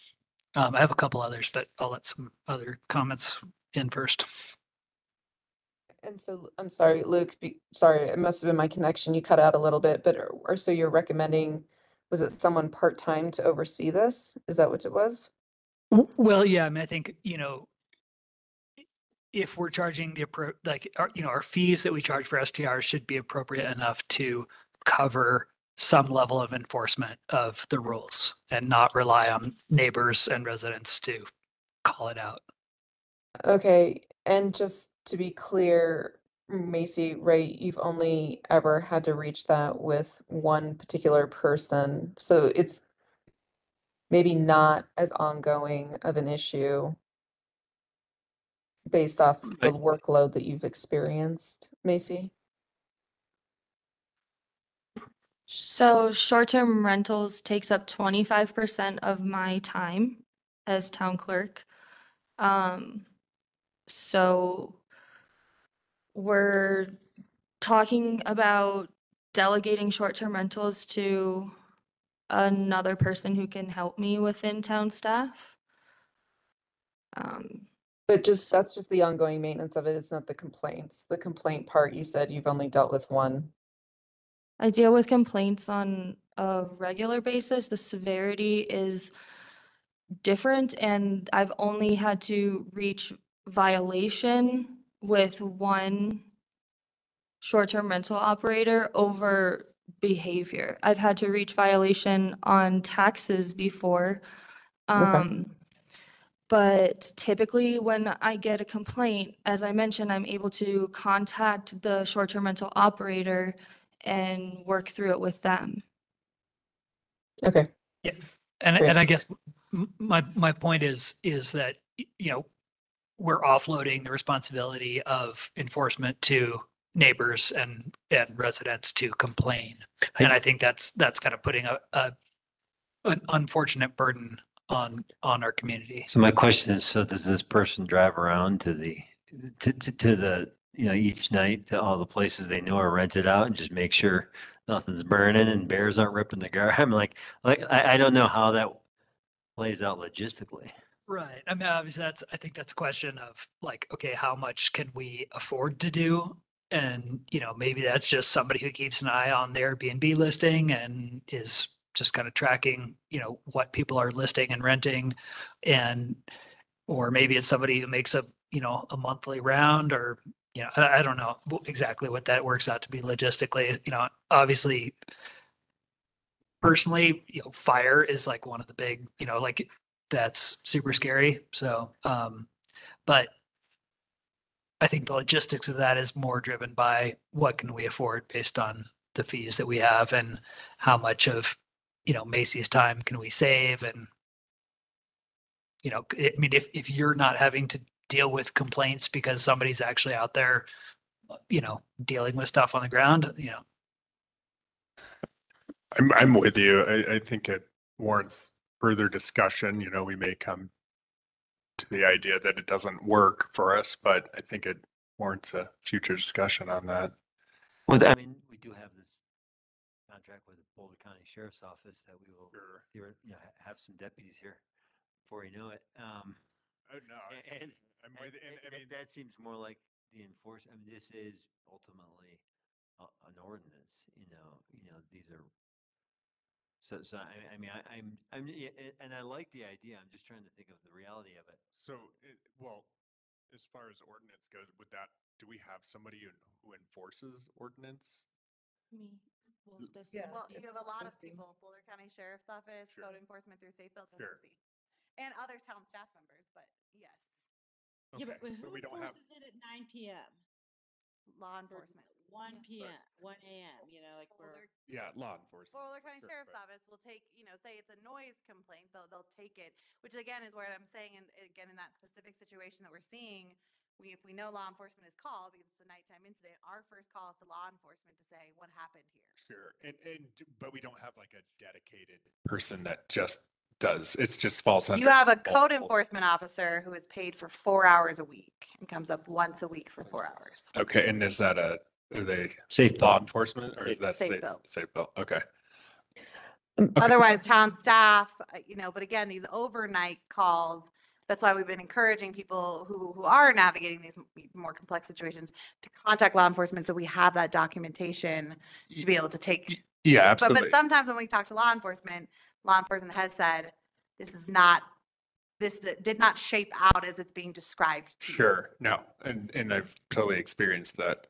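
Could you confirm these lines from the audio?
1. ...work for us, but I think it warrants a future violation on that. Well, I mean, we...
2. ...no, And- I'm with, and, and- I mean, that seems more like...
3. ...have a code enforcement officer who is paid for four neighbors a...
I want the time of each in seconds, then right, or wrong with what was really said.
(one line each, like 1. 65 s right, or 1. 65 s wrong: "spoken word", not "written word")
1. 213 s wrong: "discussion", not "violation"
2. 226 s right
3. 285 s wrong: "hours", not "neighbors".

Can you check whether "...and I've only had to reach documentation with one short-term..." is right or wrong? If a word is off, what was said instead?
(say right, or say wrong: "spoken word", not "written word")
wrong: "violation", not "documentation".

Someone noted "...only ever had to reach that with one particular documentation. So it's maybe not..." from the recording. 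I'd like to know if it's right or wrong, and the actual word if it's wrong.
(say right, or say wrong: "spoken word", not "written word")
wrong: "person", not "documentation".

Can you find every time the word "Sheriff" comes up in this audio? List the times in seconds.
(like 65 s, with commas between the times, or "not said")
221 s, 252 s, 266 s.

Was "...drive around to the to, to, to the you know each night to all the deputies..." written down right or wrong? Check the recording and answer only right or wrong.
wrong.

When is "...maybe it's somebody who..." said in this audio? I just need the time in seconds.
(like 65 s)
167 s.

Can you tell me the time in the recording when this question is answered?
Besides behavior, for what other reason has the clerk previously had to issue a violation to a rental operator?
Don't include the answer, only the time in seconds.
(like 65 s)
102 s.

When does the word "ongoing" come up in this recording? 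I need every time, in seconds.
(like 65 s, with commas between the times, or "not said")
45 s, 79 s.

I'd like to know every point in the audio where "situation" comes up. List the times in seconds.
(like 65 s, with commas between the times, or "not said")
272 s, 305 s.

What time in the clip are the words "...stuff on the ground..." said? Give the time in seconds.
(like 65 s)
202 s.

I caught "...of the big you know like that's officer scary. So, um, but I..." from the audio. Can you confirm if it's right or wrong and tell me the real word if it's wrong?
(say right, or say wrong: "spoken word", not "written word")
wrong: "super", not "officer".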